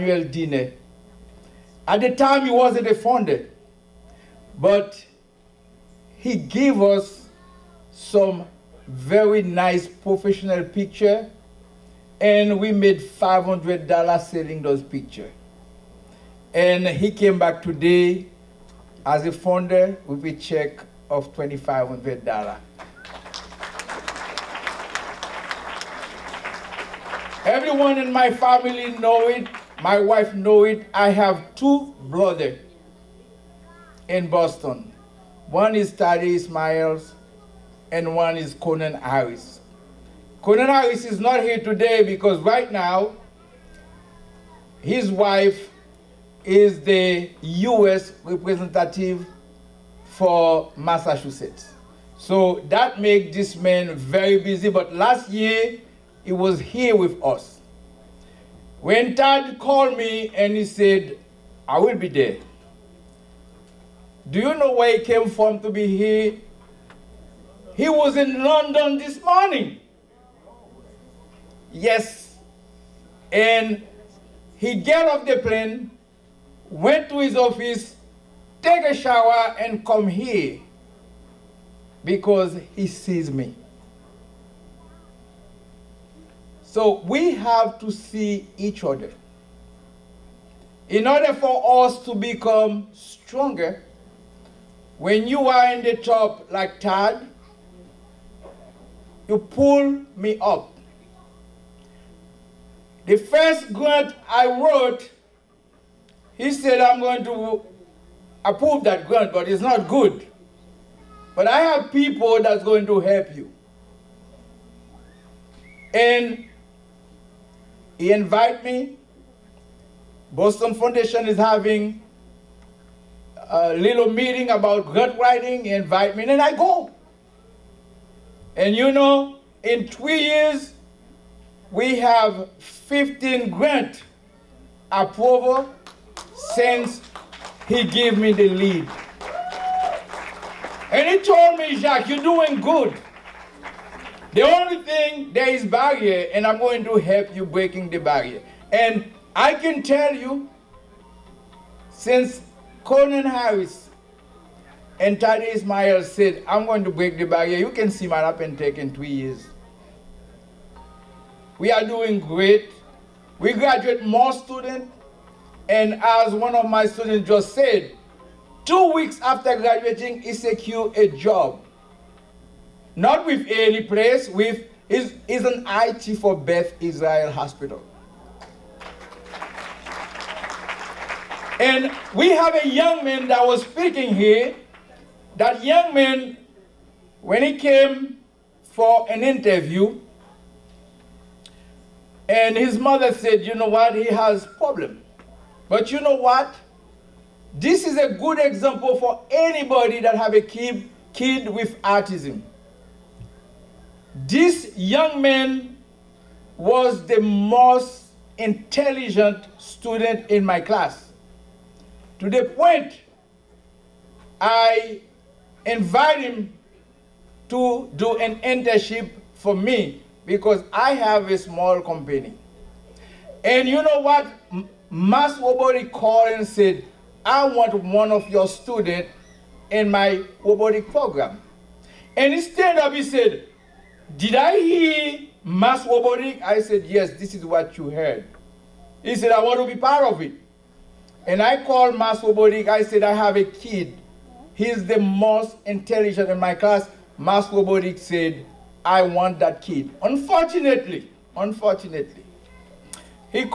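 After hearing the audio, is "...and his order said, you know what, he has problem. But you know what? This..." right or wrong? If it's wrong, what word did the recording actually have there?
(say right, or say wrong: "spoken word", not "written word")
wrong: "mother", not "order".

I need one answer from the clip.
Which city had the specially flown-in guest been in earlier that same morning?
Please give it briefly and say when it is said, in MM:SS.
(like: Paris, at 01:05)
London, at 01:08.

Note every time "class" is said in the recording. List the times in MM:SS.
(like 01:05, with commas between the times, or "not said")
03:30, 04:06.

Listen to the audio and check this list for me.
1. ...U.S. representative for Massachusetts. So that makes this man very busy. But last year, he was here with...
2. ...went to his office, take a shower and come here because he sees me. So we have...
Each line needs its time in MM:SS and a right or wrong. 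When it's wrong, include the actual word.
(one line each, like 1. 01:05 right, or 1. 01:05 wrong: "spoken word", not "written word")
1. 00:47 right
2. 01:16 right.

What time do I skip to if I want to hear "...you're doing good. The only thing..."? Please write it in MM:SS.
02:22.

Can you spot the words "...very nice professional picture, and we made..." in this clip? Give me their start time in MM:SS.
00:08.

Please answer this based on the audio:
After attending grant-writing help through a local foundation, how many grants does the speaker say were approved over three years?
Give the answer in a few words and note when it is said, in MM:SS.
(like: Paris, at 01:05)
15, at 02:12.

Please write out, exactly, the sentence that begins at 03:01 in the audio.
And we have a young man that was speaking here.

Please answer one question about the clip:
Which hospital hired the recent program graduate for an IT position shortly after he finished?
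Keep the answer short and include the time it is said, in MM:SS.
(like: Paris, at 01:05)
Beth Israel Hospital, at 02:56.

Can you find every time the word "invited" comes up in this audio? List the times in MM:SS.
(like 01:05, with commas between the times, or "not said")
01:58, 02:05, 03:35.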